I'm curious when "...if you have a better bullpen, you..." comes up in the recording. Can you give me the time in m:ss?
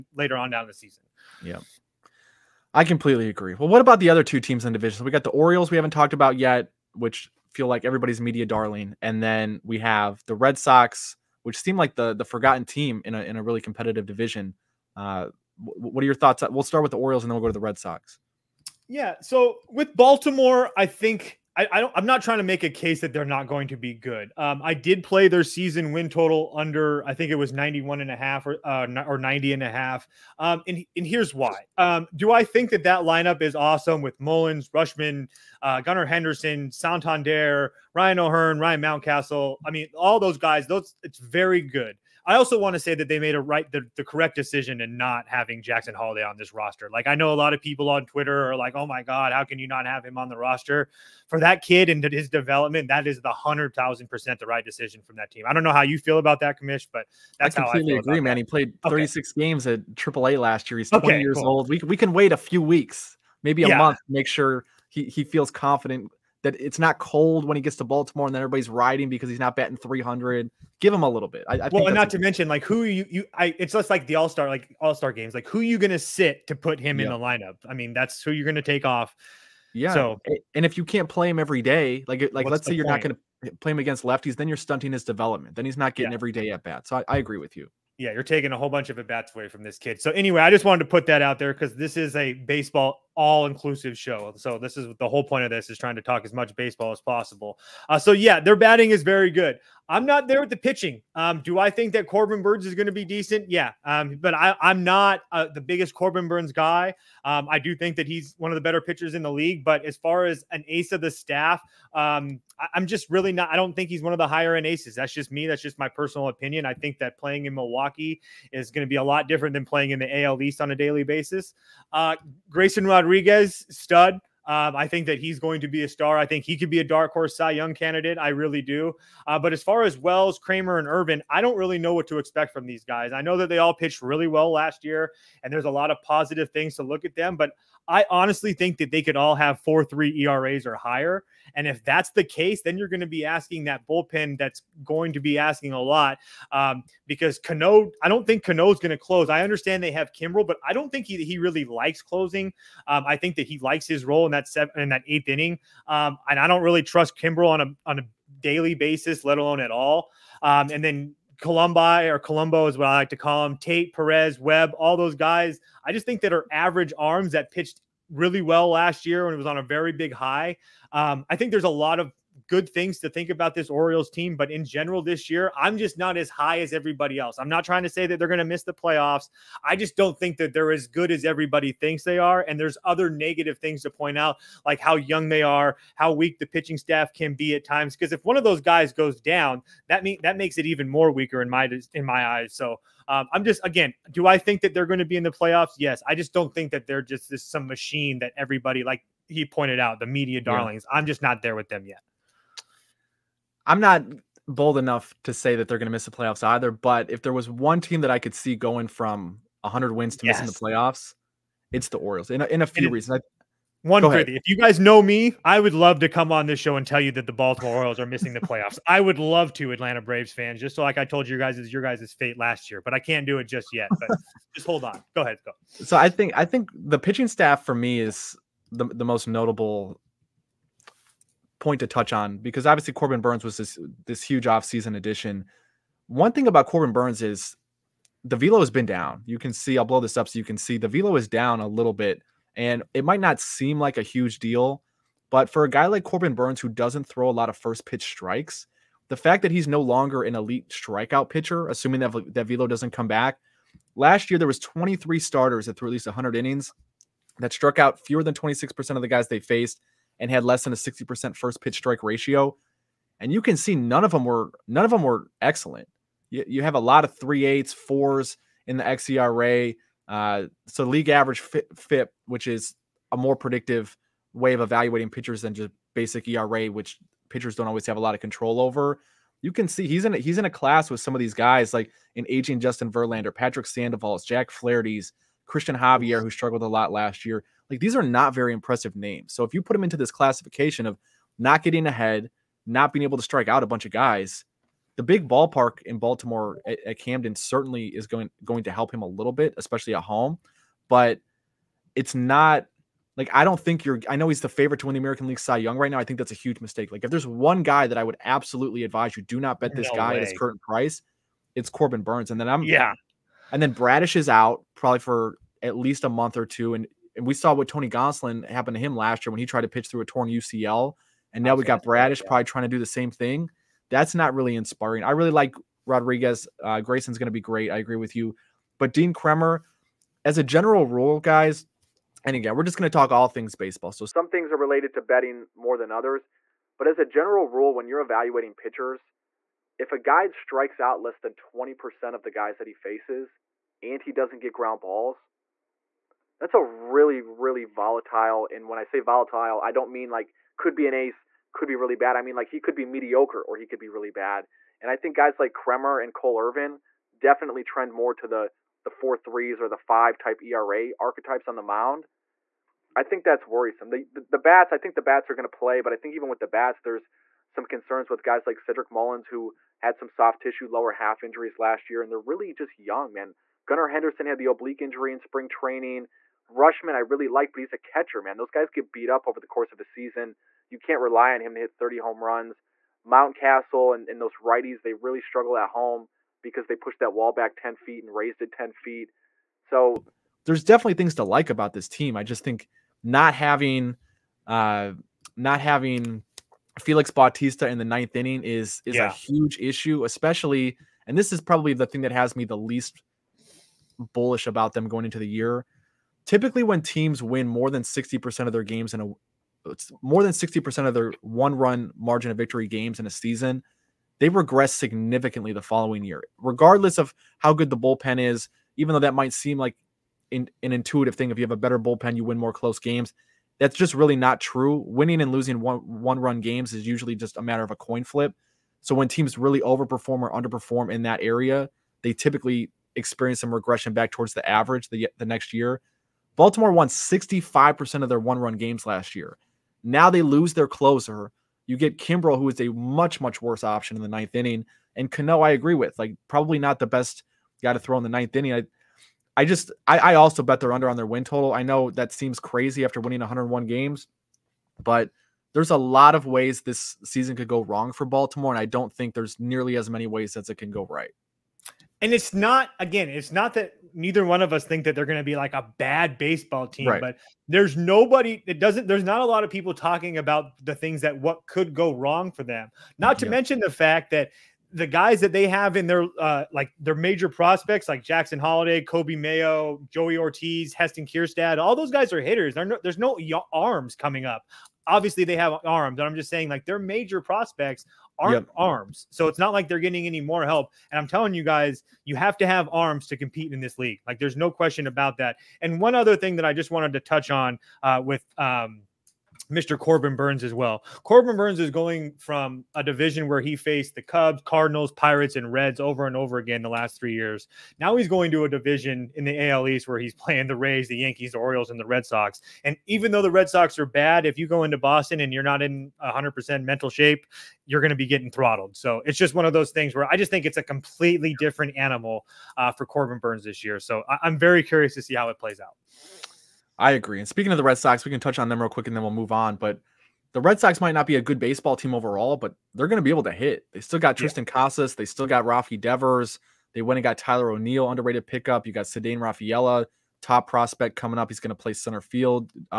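7:01.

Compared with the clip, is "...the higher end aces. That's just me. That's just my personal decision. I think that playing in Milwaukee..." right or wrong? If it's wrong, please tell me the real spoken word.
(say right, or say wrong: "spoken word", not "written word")
wrong: "opinion", not "decision".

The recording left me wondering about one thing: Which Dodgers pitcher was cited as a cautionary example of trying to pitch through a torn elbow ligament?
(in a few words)
Tony Gonsolin.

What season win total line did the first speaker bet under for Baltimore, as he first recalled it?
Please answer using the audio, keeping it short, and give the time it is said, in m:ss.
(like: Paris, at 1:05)
91.5, at 0:27.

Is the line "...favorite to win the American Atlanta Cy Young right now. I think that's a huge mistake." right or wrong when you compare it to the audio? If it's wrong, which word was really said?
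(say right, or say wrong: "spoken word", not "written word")
wrong: "League", not "Atlanta".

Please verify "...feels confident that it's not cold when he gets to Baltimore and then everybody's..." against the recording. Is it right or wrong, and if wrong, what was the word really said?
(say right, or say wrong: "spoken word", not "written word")
right.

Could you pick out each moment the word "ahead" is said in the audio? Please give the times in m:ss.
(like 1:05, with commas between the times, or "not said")
3:45, 4:51.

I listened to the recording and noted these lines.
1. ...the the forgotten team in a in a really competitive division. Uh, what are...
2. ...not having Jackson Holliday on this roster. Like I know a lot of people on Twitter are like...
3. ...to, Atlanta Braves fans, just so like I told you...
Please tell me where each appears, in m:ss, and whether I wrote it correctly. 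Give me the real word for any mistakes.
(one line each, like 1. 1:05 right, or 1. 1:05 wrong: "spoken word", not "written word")
1. 0:11 right
2. 0:44 right
3. 3:39 right.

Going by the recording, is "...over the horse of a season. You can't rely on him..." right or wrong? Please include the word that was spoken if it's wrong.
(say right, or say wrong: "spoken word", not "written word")
wrong: "course", not "horse".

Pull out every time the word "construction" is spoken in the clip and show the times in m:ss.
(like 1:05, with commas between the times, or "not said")
not said.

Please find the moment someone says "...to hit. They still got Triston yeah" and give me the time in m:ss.
8:53.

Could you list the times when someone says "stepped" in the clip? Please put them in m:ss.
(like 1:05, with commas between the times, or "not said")
not said.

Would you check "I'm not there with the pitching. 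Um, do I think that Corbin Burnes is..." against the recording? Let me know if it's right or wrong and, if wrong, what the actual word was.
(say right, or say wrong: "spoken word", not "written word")
right.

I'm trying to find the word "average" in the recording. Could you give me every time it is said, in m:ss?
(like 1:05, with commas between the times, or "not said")
2:46, 4:31, 7:14.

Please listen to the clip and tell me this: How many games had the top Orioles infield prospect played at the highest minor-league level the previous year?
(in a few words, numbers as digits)
36.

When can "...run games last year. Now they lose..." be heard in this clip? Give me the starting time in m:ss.
7:18.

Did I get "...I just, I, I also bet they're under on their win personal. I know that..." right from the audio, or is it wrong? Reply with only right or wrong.
wrong.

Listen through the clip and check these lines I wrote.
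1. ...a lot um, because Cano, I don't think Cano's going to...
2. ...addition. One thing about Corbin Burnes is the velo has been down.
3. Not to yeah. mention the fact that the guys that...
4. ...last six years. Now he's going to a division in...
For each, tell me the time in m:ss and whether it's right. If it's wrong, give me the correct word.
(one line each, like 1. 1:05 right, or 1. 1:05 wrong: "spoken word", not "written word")
1. 2:25 right
2. 3:54 right
3. 7:52 right
4. 8:26 wrong: "three", not "six".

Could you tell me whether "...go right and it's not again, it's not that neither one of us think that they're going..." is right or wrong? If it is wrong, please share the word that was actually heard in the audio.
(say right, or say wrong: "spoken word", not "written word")
right.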